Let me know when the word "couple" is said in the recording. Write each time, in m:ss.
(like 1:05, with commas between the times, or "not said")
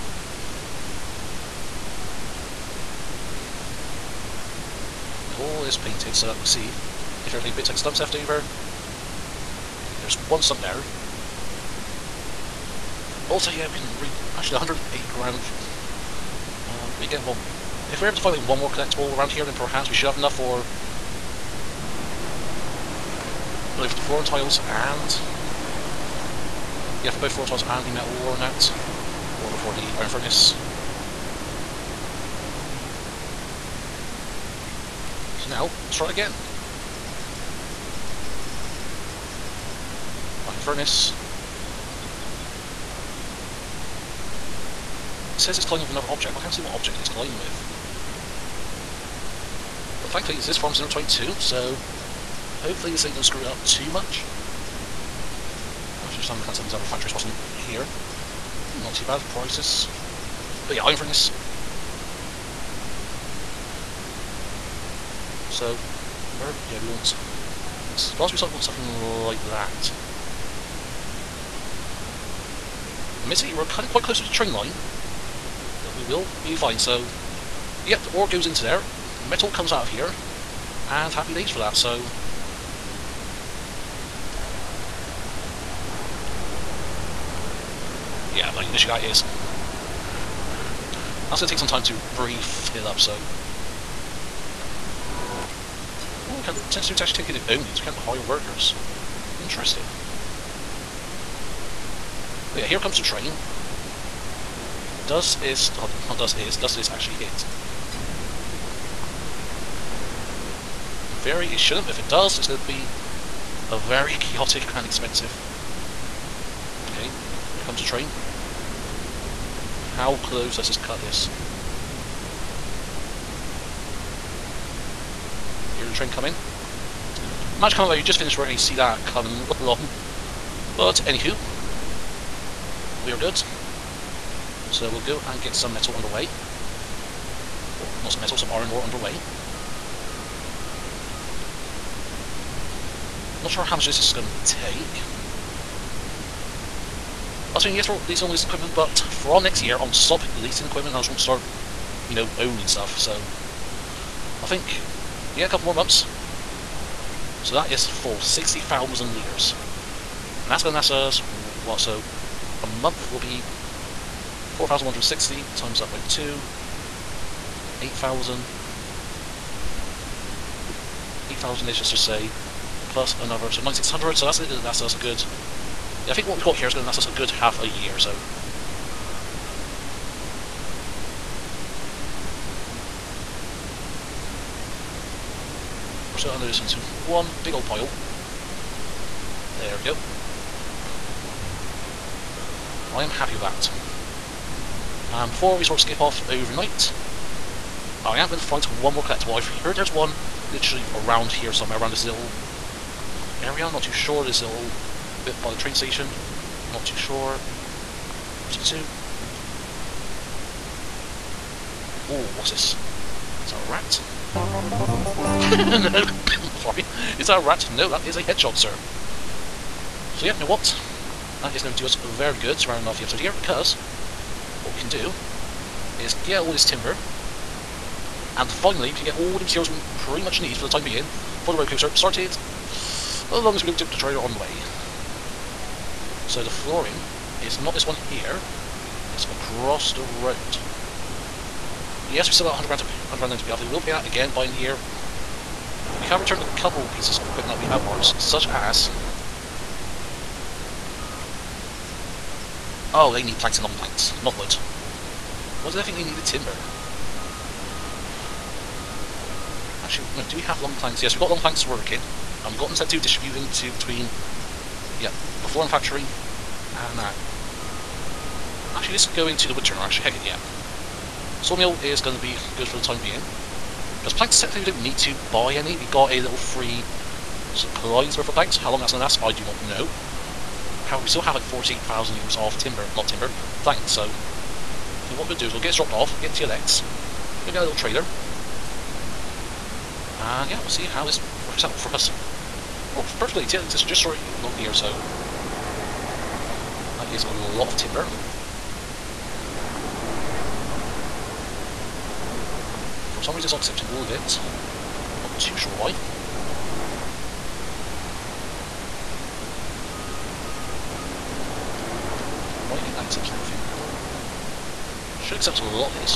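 2:35, 4:06.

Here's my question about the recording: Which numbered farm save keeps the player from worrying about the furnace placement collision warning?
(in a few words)
22.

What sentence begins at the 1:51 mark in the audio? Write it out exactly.
But If it does, it's going to be a very chaotic and expensive.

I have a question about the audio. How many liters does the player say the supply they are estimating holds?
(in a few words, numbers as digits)
60,000 liters.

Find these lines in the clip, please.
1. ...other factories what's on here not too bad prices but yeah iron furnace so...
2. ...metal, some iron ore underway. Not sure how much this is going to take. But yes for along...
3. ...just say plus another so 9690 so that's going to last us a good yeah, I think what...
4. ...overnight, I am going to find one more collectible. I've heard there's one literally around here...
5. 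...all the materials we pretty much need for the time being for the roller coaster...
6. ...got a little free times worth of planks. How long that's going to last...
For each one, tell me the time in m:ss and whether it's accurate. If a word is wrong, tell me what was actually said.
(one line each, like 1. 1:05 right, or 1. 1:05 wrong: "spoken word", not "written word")
1. 0:56 right
2. 2:18 wrong: "leasing", not "along"
3. 2:51 wrong: "9600", not "9690"
4. 3:16 right
5. 3:49 right
6. 4:35 wrong: "supplies", not "times".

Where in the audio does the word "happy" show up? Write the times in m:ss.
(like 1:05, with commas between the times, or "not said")
1:21, 3:13.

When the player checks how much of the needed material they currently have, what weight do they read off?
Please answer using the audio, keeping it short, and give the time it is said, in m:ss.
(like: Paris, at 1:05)
180 grams, at 0:14.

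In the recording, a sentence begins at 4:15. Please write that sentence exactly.
What did I think they needed timber?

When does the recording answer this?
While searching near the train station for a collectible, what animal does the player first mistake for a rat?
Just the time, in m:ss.
3:38.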